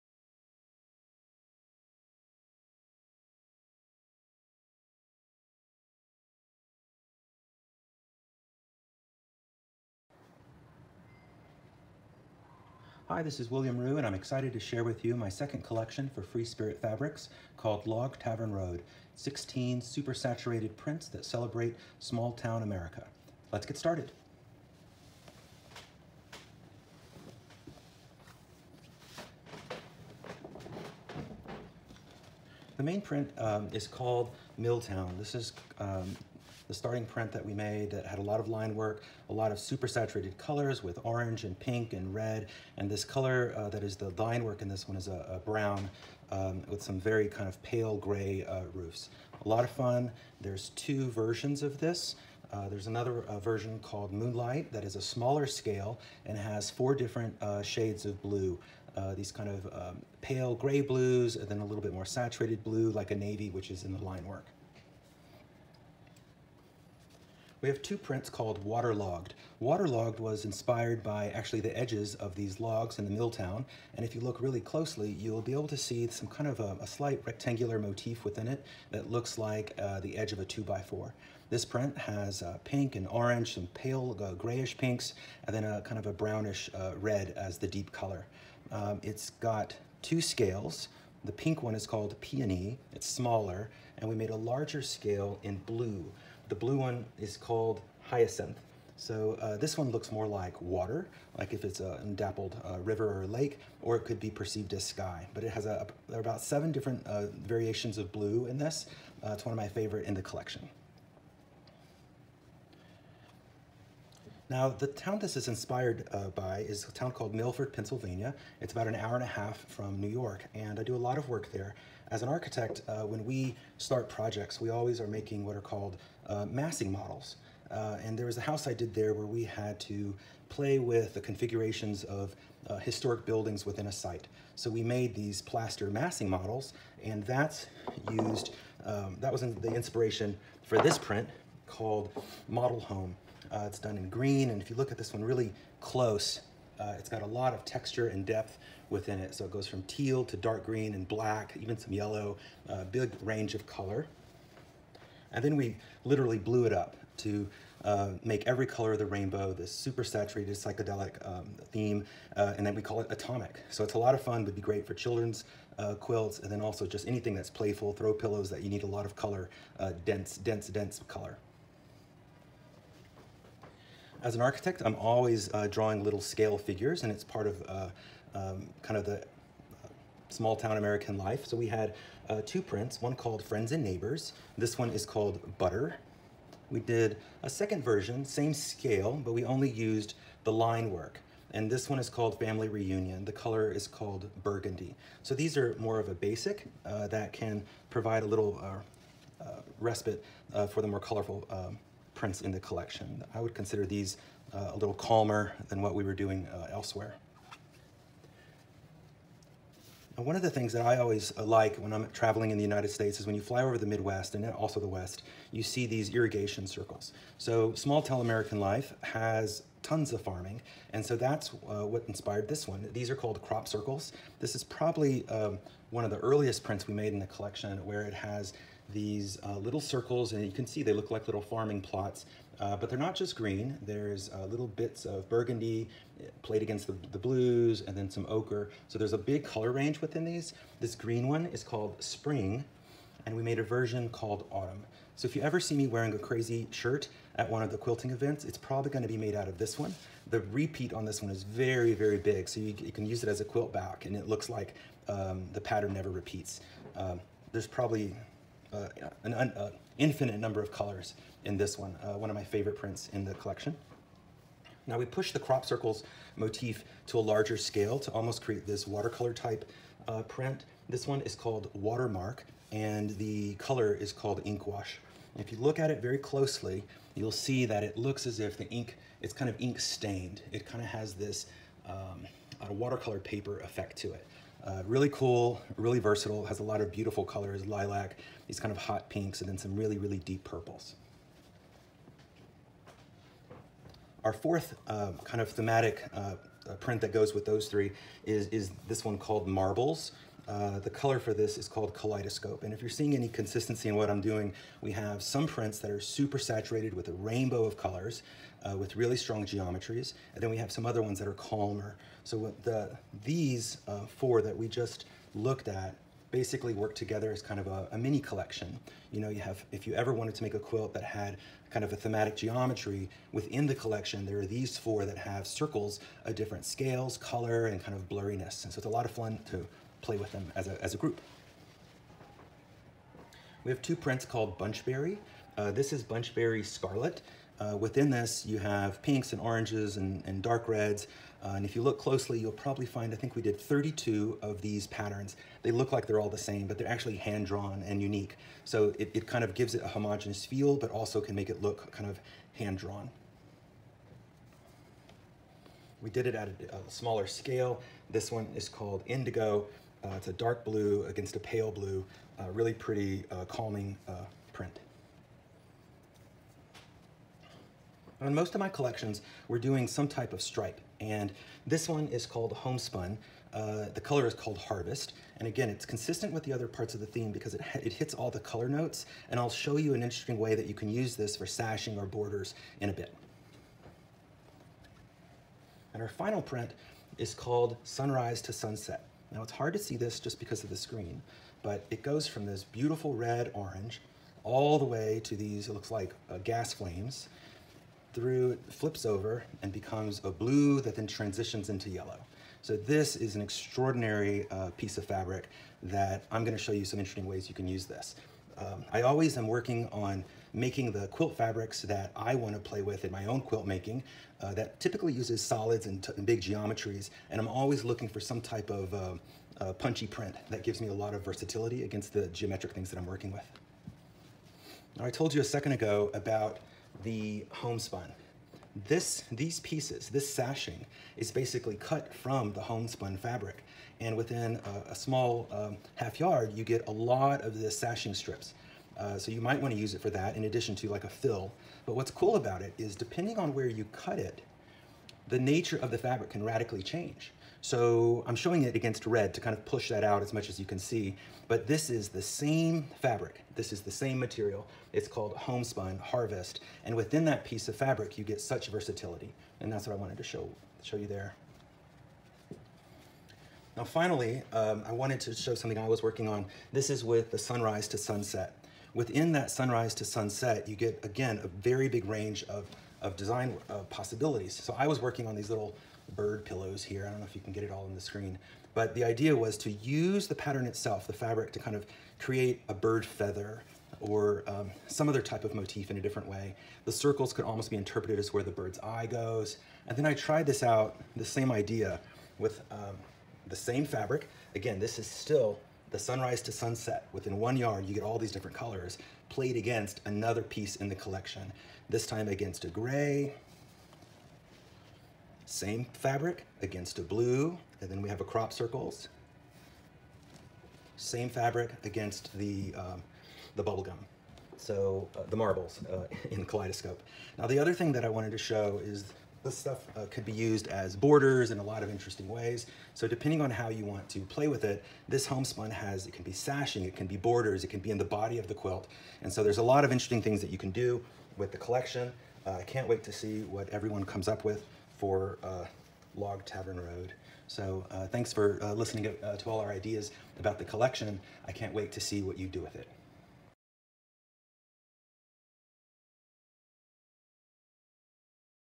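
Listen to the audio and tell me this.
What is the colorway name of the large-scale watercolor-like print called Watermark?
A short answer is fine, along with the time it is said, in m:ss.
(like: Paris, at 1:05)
Ink Wash, at 4:34.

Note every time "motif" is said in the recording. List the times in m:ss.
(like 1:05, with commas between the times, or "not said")
1:17, 4:26, 8:05.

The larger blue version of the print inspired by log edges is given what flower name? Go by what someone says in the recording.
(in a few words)
Hyacinth.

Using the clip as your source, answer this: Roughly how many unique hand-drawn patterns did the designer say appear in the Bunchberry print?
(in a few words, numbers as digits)
32.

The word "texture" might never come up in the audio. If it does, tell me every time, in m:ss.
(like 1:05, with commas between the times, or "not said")
2:27.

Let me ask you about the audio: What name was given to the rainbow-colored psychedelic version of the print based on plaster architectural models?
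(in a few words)
Atomic.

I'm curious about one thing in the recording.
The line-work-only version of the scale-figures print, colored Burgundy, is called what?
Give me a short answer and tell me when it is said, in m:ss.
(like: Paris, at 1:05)
Family Reunion, at 3:12.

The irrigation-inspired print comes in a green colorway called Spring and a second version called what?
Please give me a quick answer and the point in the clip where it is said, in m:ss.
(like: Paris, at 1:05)
Autumn, at 4:04.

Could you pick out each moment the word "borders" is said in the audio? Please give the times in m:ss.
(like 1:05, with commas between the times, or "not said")
6:22, 8:40, 8:47.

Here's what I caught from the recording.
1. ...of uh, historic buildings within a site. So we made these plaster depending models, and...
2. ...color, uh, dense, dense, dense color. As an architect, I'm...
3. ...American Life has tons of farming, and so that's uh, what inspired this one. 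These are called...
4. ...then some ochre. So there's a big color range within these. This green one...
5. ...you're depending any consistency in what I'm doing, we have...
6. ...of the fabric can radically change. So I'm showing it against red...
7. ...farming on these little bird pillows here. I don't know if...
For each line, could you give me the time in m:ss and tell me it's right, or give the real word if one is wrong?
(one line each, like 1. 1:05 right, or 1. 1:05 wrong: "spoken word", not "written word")
1. 2:12 wrong: "massing", not "depending"
2. 2:49 right
3. 3:38 right
4. 3:57 right
5. 5:02 wrong: "seeing", not "depending"
6. 7:25 right
7. 7:55 wrong: "working", not "farming".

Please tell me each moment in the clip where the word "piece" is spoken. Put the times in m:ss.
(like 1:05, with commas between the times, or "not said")
6:44, 7:09, 7:37, 8:20.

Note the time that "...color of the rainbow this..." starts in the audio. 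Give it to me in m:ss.
2:38.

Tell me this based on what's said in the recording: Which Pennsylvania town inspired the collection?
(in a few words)
Milford.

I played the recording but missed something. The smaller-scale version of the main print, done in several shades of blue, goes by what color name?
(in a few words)
Moonlight.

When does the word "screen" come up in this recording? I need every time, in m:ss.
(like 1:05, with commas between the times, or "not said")
6:30, 7:58.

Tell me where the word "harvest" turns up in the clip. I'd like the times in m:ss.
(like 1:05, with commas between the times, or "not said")
6:14, 7:35.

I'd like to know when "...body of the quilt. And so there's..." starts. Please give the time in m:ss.
8:48.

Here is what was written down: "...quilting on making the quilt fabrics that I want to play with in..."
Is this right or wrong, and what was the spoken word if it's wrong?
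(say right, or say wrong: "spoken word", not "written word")
wrong: "working", not "quilting".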